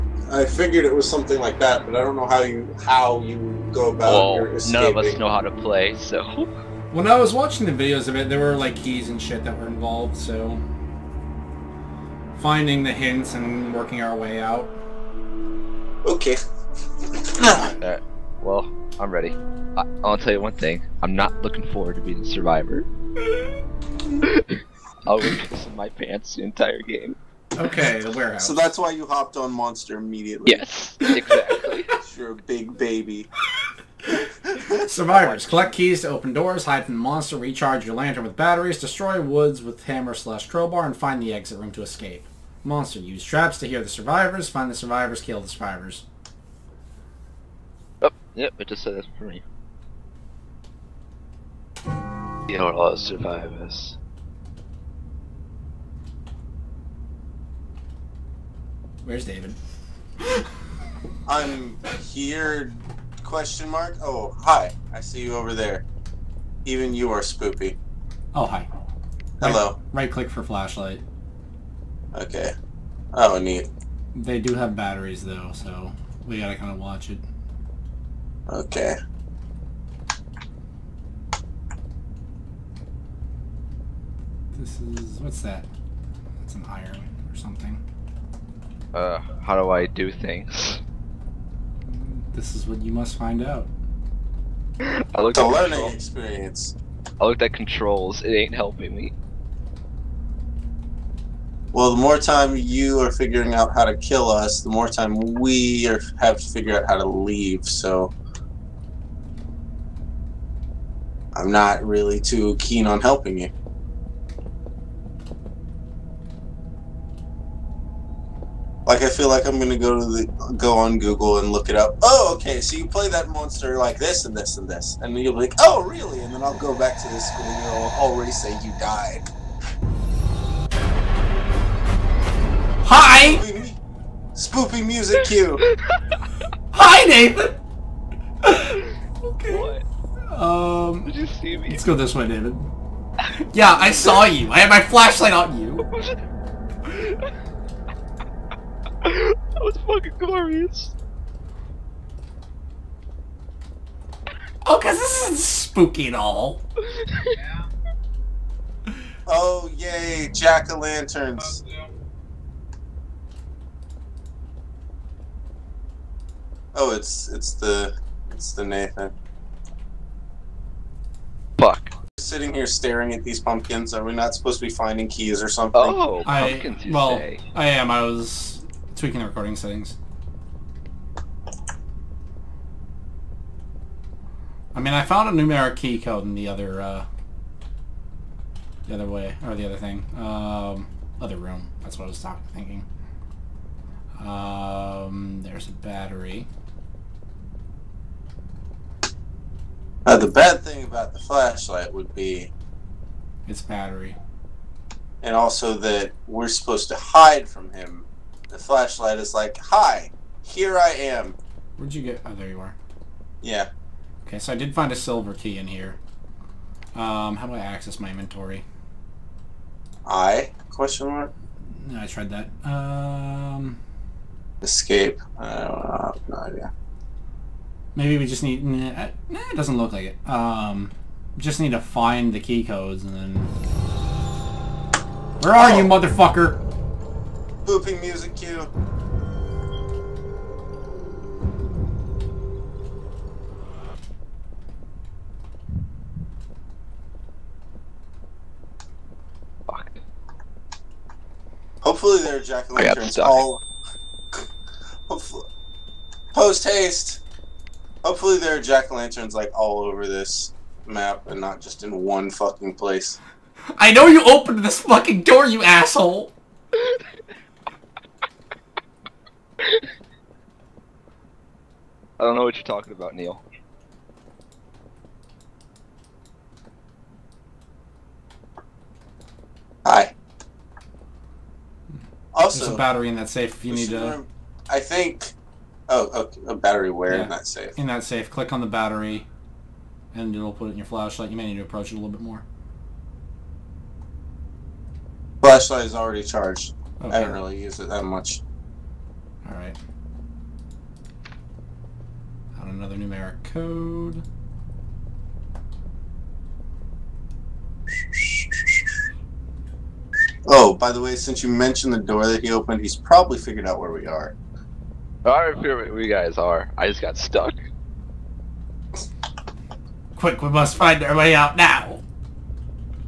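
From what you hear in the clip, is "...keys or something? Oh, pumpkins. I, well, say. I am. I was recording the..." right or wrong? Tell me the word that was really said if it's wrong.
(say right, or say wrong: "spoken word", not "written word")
wrong: "tweaking", not "recording".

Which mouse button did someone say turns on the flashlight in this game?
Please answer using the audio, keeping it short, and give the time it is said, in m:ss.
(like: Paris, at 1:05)
right click, at 1:10.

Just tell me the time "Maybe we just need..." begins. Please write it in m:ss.
3:47.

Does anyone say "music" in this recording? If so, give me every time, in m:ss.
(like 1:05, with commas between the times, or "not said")
2:14, 3:57.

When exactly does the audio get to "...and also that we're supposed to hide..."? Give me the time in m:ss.
3:25.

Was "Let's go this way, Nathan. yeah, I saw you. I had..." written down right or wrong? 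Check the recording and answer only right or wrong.
wrong.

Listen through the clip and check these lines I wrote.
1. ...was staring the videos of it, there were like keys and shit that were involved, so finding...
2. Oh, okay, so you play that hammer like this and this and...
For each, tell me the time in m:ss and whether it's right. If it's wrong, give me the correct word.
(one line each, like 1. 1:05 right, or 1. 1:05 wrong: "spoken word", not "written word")
1. 0:07 wrong: "watching", not "staring"
2. 2:02 wrong: "monster", not "hammer".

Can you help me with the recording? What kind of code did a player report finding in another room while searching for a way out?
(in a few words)
numeric key code.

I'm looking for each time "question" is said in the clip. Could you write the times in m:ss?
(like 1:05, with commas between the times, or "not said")
1:03, 3:40.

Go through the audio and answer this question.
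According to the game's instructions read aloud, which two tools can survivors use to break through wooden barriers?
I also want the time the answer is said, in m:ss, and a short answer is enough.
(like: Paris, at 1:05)
hammer slash crowbar, at 0:39.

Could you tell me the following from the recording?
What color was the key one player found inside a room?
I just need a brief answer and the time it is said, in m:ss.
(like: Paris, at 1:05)
silver, at 3:34.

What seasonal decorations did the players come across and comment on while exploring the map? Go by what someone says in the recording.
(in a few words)
jack-o'-lanterns.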